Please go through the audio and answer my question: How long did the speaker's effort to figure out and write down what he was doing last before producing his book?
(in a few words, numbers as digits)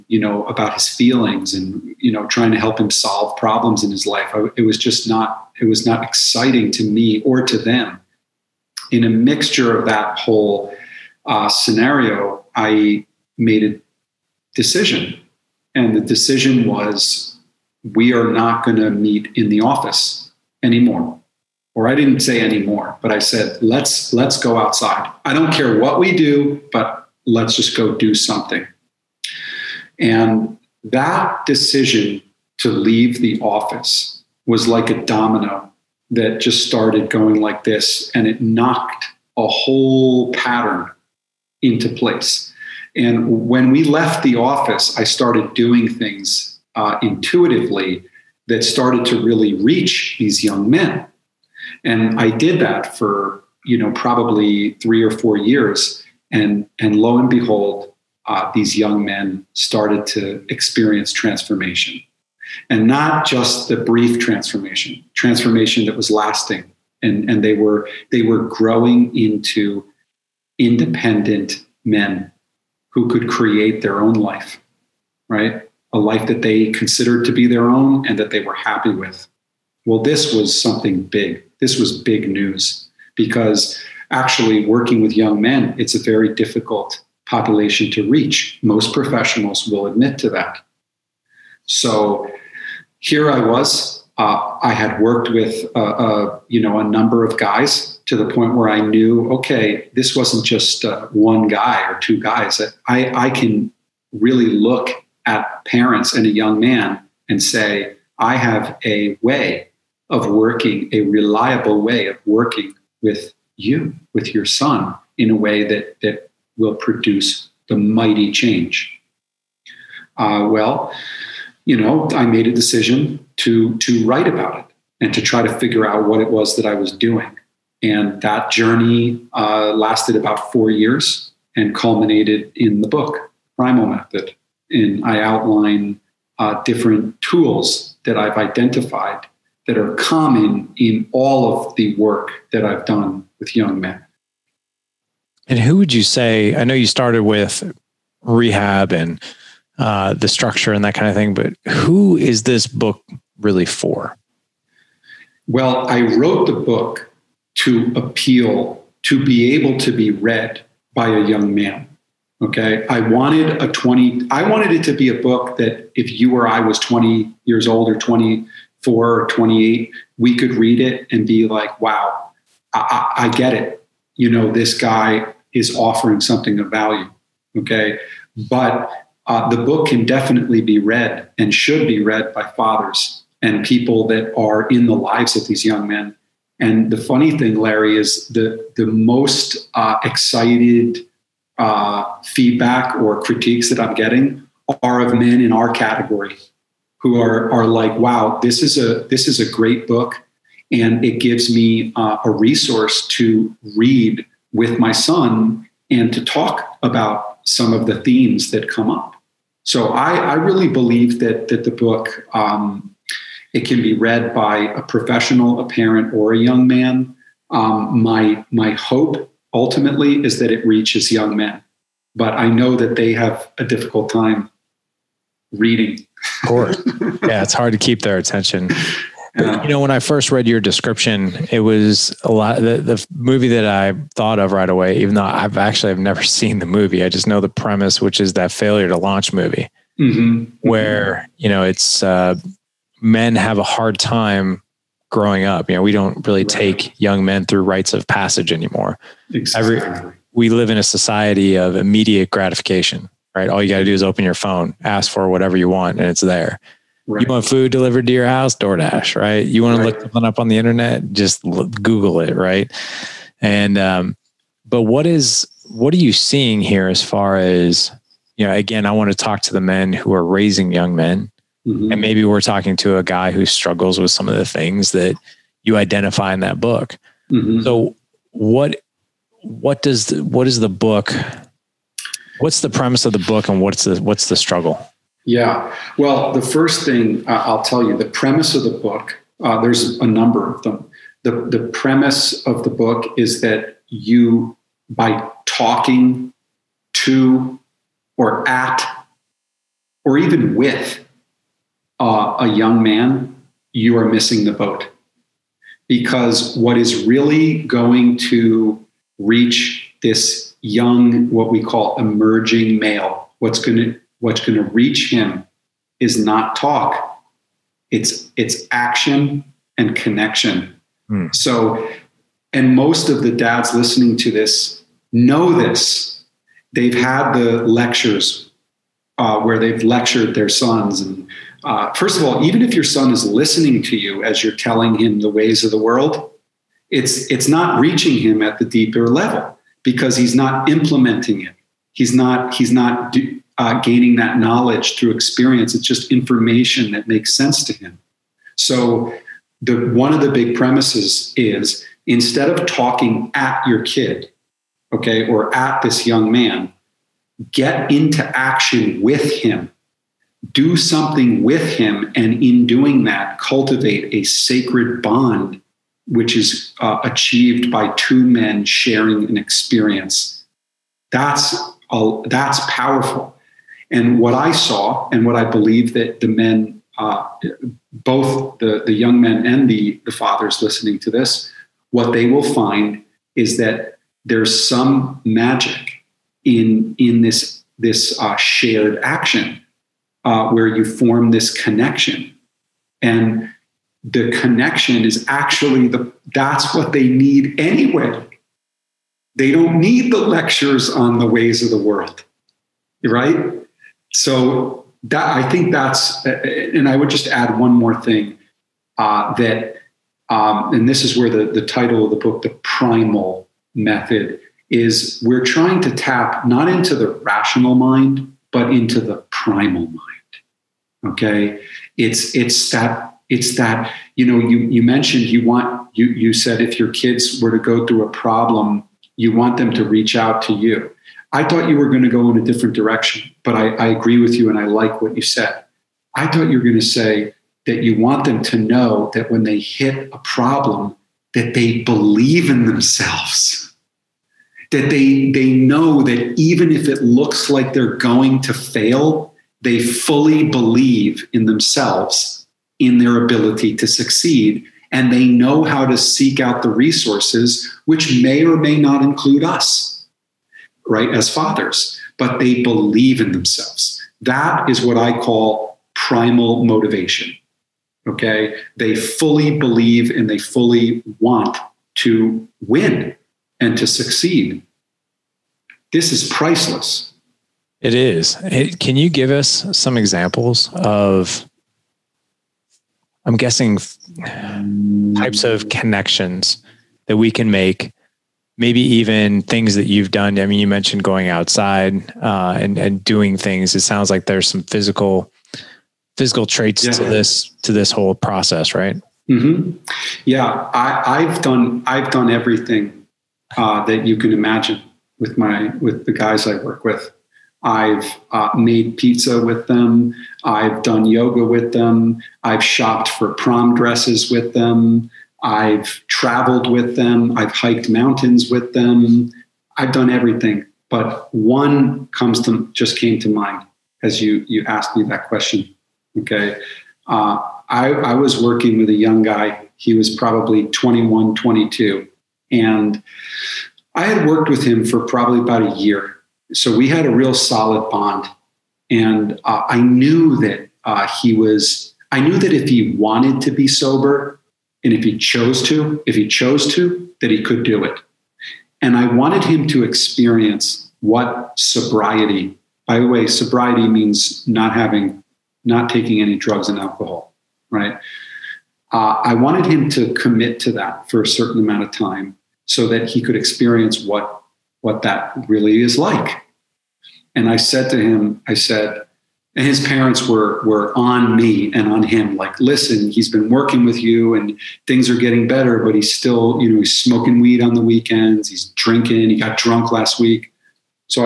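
about 4 years.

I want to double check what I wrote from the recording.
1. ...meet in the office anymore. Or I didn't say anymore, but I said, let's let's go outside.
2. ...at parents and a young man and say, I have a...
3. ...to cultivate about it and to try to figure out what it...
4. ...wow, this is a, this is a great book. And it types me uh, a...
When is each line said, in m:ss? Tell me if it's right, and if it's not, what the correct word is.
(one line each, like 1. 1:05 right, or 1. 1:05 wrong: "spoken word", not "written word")
1. 0:18 right
2. 1:45 right
3. 2:03 wrong: "write", not "cultivate"
4. 3:17 wrong: "gives", not "types".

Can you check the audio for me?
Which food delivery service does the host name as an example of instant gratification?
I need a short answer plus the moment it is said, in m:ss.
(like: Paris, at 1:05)
DoorDash, at 4:18.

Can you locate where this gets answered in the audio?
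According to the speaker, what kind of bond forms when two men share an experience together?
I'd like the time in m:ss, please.
6:04.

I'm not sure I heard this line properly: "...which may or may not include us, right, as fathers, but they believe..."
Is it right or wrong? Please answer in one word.
right.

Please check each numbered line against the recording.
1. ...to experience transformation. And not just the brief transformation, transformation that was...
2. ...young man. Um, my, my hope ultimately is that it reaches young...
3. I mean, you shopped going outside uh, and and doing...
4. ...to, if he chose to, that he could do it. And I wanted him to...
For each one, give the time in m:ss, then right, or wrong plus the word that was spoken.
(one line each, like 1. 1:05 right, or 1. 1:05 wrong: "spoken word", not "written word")
1. 1:00 right
2. 3:36 right
3. 8:10 wrong: "mentioned", not "shopped"
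4. 9:05 right.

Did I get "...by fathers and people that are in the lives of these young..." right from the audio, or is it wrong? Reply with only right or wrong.
right.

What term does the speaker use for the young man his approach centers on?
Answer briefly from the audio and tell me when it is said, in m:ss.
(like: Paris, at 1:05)
emerging male, at 5:11.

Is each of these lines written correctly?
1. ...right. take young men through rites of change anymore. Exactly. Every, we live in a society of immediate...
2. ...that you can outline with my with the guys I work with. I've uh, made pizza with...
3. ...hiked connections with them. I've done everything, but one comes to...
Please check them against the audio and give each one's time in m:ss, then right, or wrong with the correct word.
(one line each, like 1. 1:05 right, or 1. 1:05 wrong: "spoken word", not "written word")
1. 4:06 wrong: "passage", not "change"
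2. 8:23 wrong: "imagine", not "outline"
3. 8:37 wrong: "mountains", not "connections".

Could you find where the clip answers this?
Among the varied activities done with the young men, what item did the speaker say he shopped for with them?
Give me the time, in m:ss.
8:33.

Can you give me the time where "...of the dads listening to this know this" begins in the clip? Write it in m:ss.
5:23.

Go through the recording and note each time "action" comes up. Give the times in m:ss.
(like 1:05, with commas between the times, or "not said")
5:18, 5:58, 6:29.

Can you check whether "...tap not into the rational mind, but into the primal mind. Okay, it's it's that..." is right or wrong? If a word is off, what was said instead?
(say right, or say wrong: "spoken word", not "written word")
right.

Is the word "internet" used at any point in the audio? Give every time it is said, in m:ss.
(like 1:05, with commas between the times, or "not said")
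4:20.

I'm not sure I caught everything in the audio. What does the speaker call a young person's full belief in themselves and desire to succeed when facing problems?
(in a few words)
primal motivation.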